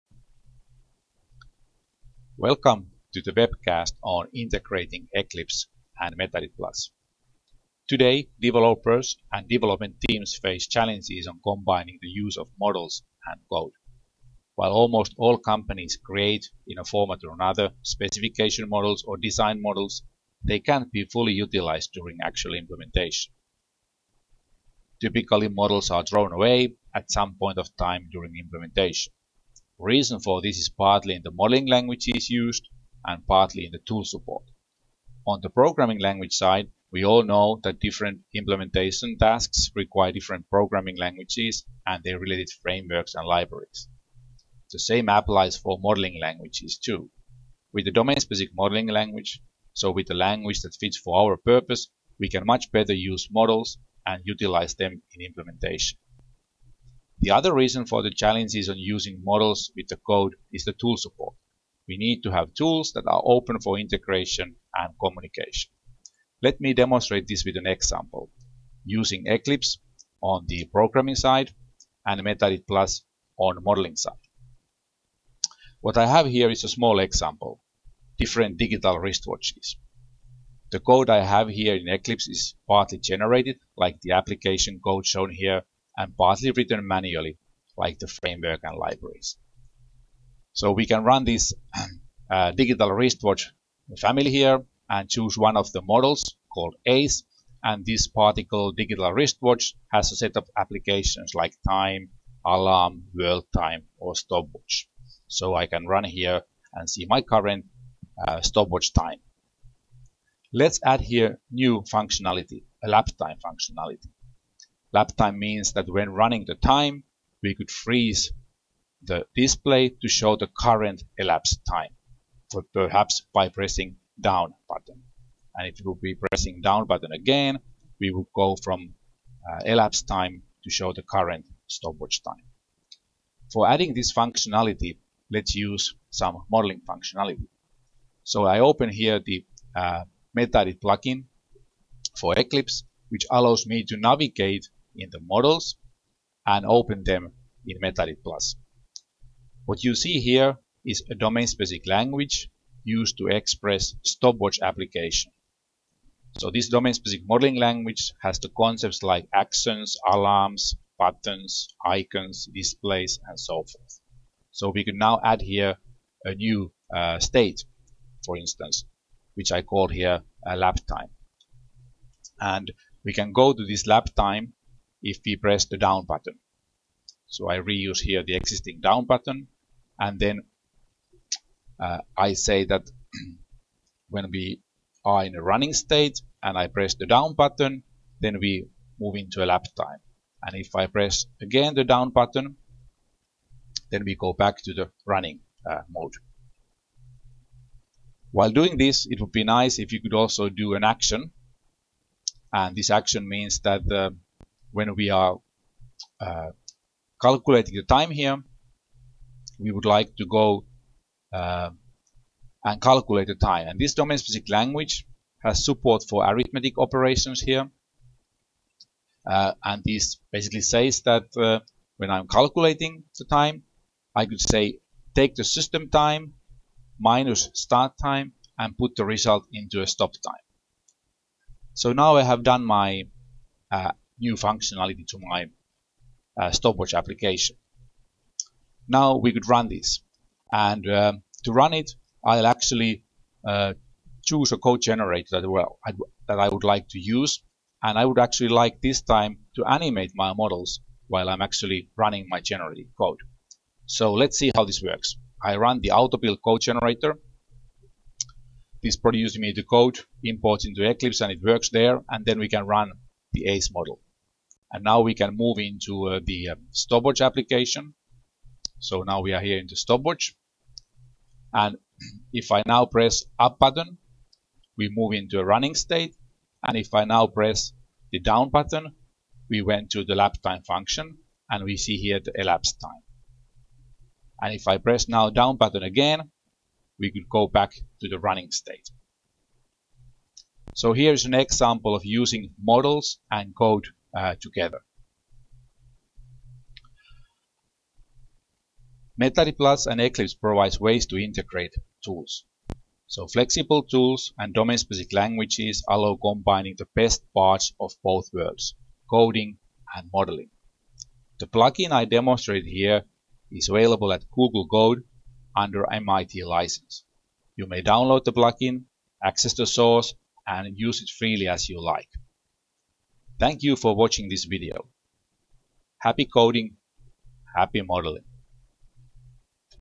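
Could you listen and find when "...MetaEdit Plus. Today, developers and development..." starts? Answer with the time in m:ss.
0:06.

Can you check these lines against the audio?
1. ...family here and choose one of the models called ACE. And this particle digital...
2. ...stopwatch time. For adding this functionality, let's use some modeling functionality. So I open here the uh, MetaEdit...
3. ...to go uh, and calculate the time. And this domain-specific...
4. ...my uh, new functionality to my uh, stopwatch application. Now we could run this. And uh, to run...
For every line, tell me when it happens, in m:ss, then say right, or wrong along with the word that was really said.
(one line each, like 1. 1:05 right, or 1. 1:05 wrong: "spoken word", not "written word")
1. 1:33 right
2. 2:11 right
3. 3:30 right
4. 3:52 right.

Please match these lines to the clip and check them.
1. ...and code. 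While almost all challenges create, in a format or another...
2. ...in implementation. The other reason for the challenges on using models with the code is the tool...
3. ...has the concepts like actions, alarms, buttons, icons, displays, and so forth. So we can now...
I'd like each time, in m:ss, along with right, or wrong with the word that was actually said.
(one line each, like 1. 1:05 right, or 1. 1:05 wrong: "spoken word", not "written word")
1. 0:13 wrong: "companies", not "challenges"
2. 0:55 right
3. 2:38 right.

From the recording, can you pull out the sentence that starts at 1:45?
So I can run here and see my current uh, stopwatch time.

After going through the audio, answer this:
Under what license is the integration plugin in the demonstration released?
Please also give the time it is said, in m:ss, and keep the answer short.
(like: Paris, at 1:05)
MIT license, at 5:15.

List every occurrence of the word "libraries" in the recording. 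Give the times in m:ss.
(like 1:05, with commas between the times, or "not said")
0:43, 1:28.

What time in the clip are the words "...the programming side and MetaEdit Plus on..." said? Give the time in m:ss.
1:10.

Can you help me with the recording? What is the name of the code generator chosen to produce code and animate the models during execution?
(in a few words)
AutoBuild.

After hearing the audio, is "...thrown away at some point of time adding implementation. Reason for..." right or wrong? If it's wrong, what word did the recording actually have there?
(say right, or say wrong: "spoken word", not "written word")
wrong: "during", not "adding".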